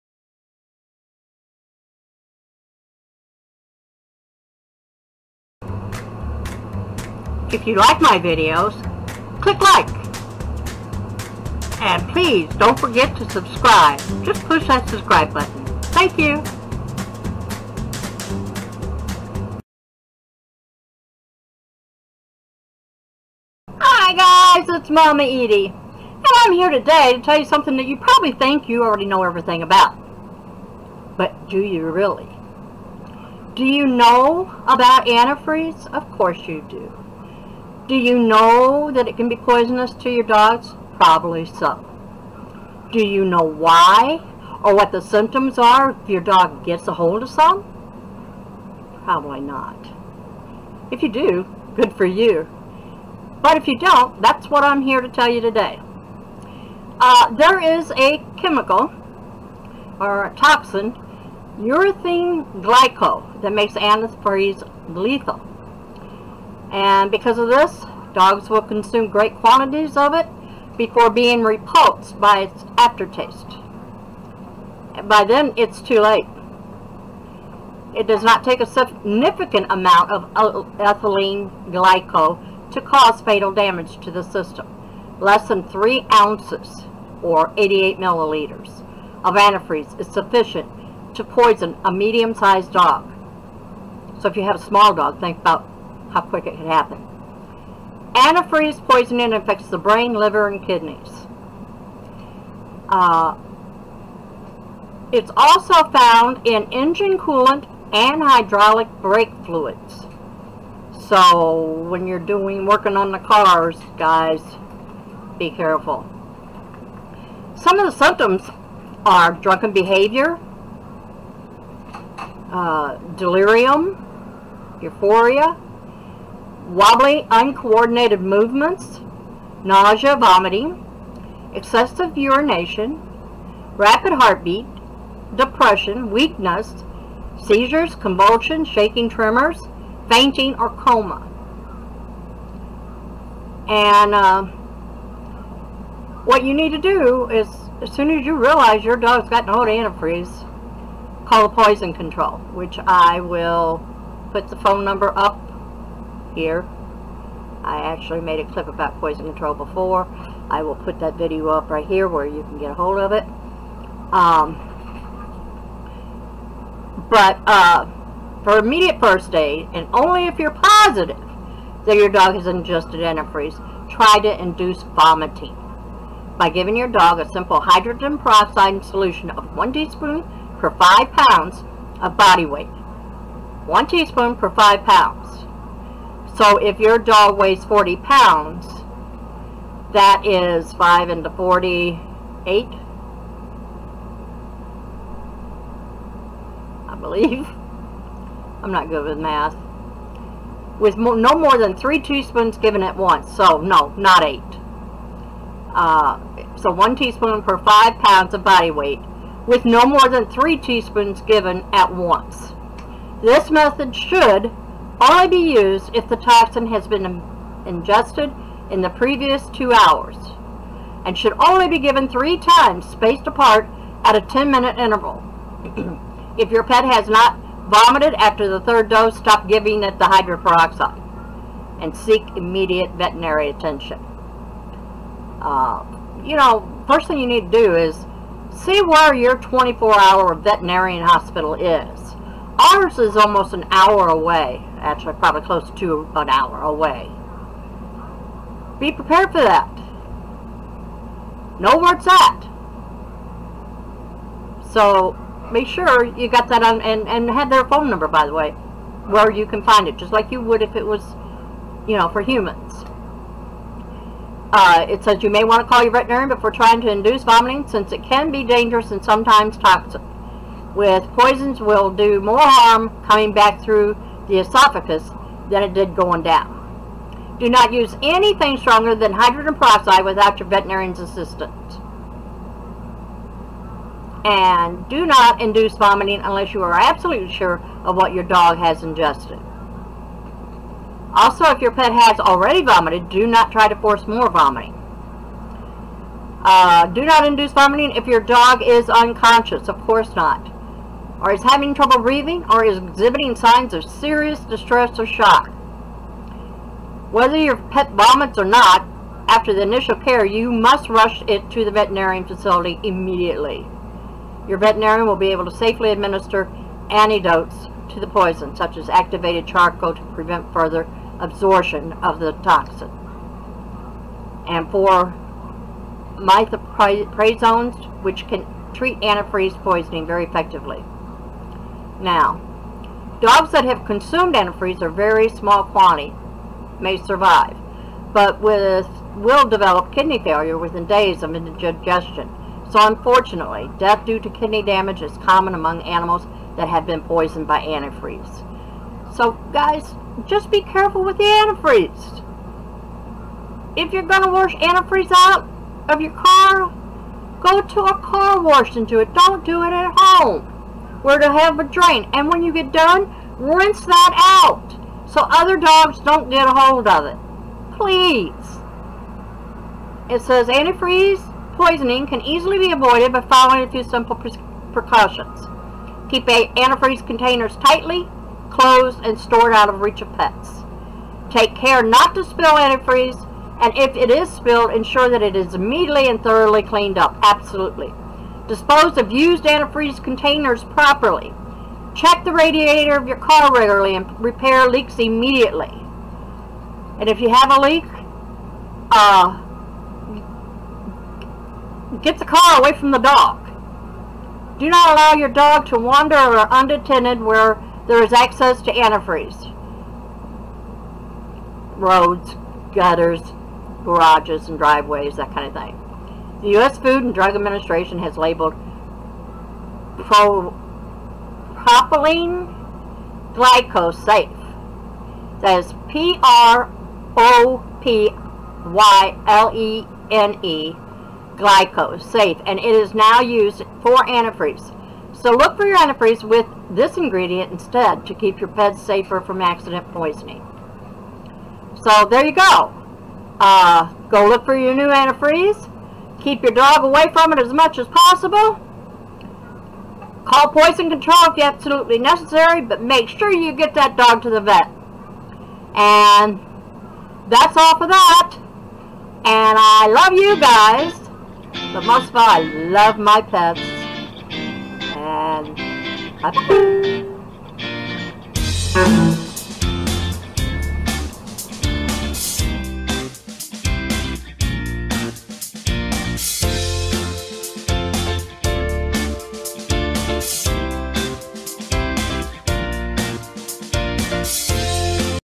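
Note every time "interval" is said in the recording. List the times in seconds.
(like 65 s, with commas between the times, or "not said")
224 s.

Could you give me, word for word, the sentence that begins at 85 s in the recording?
Less than 3 ounces, or 88 milliliters, of antifreeze is sufficient to poison a medium-sized dog.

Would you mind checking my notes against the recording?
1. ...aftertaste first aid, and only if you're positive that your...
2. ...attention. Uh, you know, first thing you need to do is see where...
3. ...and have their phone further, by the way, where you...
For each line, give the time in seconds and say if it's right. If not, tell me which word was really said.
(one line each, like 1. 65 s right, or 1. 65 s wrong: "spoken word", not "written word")
1. 168 s wrong: "immediate", not "aftertaste"
2. 233 s right
3. 257 s wrong: "number", not "further".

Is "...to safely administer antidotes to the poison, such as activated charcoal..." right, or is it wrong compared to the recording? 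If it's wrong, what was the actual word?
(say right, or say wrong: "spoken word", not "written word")
right.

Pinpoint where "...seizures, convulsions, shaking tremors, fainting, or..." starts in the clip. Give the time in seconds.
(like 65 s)
137 s.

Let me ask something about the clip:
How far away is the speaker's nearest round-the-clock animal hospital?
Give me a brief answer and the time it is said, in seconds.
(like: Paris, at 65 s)
almost an hour, at 243 s.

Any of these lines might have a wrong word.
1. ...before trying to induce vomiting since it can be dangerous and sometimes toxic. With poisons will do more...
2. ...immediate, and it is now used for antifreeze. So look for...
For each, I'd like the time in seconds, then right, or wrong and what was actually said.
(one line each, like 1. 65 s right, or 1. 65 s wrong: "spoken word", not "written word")
1. 266 s right
2. 431 s wrong: "glycosate", not "immediate".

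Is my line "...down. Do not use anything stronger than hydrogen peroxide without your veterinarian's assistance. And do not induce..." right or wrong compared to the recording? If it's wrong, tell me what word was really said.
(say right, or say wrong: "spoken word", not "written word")
right.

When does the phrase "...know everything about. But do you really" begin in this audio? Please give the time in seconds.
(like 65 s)
29 s.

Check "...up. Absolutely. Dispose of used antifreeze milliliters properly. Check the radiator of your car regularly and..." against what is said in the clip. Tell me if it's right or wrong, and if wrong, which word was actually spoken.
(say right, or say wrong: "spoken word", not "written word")
wrong: "containers", not "milliliters".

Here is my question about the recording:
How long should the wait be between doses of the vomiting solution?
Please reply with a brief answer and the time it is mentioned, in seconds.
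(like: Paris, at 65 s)
10 minutes, at 224 s.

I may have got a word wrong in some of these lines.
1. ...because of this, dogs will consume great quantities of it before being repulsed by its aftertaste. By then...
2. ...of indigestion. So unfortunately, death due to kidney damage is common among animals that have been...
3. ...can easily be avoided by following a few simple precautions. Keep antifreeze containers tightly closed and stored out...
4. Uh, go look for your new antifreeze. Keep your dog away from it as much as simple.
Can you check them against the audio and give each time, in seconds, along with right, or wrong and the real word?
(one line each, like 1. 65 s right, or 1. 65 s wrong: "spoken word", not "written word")
1. 67 s right
2. 341 s right
3. 372 s right
4. 443 s wrong: "possible", not "simple".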